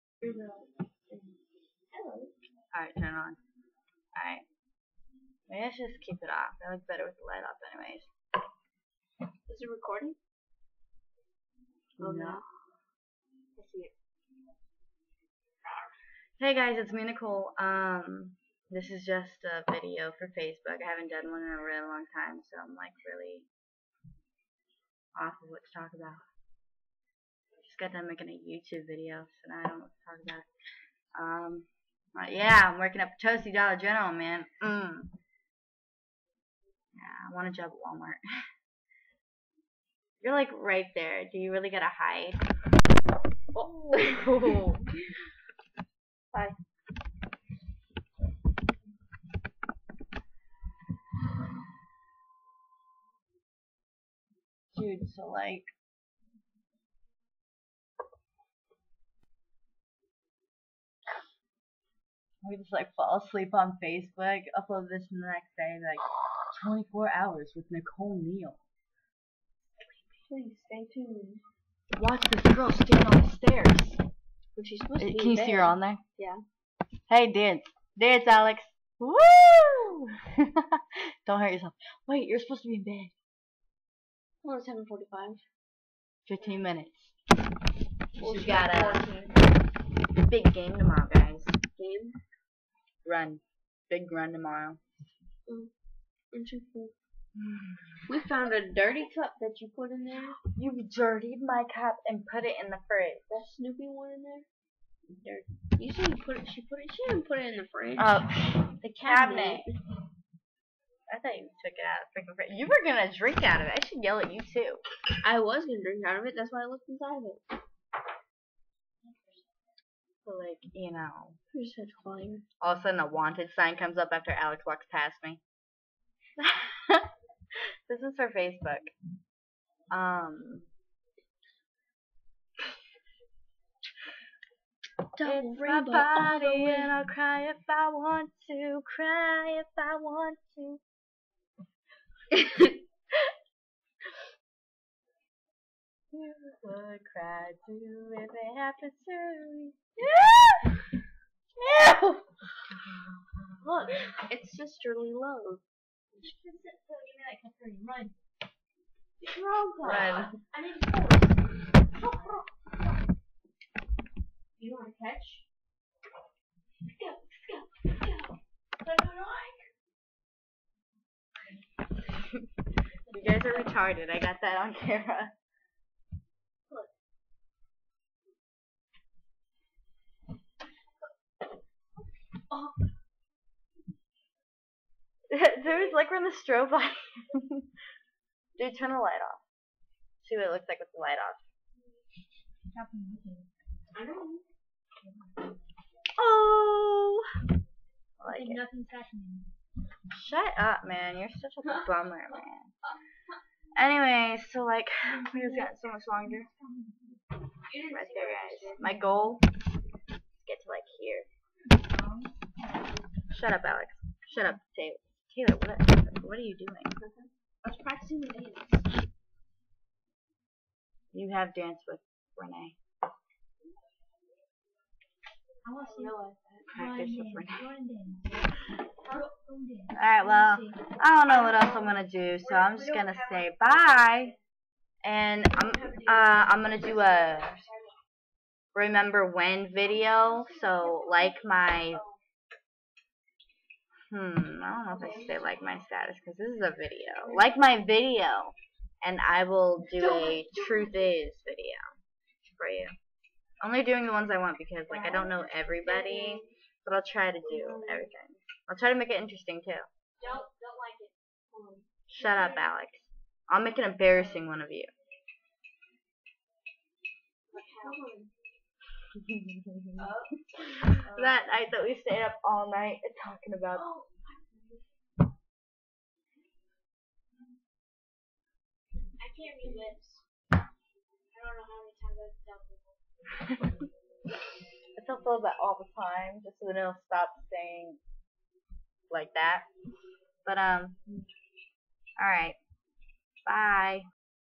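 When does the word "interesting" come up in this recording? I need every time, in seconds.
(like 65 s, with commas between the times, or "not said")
96 s, 259 s.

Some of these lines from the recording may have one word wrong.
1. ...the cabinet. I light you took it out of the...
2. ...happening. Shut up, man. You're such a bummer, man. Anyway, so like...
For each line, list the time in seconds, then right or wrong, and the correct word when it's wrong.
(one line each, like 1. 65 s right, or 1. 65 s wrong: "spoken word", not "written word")
1. 108 s wrong: "thought", not "light"
2. 198 s right.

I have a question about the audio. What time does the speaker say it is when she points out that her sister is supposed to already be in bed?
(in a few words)
7:45.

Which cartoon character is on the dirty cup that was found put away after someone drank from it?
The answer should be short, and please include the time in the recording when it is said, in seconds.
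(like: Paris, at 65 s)
Snoopy, at 103 s.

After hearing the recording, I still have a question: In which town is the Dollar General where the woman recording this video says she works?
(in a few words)
Potosi.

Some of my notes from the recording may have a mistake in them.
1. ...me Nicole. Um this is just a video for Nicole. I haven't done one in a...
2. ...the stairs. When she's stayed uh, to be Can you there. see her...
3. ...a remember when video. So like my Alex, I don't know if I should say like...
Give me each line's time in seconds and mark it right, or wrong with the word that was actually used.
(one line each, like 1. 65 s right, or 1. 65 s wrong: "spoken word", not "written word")
1. 16 s wrong: "Facebook", not "Nicole"
2. 73 s wrong: "supposed", not "stayed"
3. 236 s wrong: "Hmm", not "Alex".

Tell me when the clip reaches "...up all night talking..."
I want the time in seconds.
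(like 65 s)
272 s.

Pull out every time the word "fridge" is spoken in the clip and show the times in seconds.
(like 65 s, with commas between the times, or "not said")
102 s, 107 s, 112 s.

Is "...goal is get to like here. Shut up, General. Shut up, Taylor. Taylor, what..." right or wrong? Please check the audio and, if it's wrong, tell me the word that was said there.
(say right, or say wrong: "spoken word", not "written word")
wrong: "Alex", not "General".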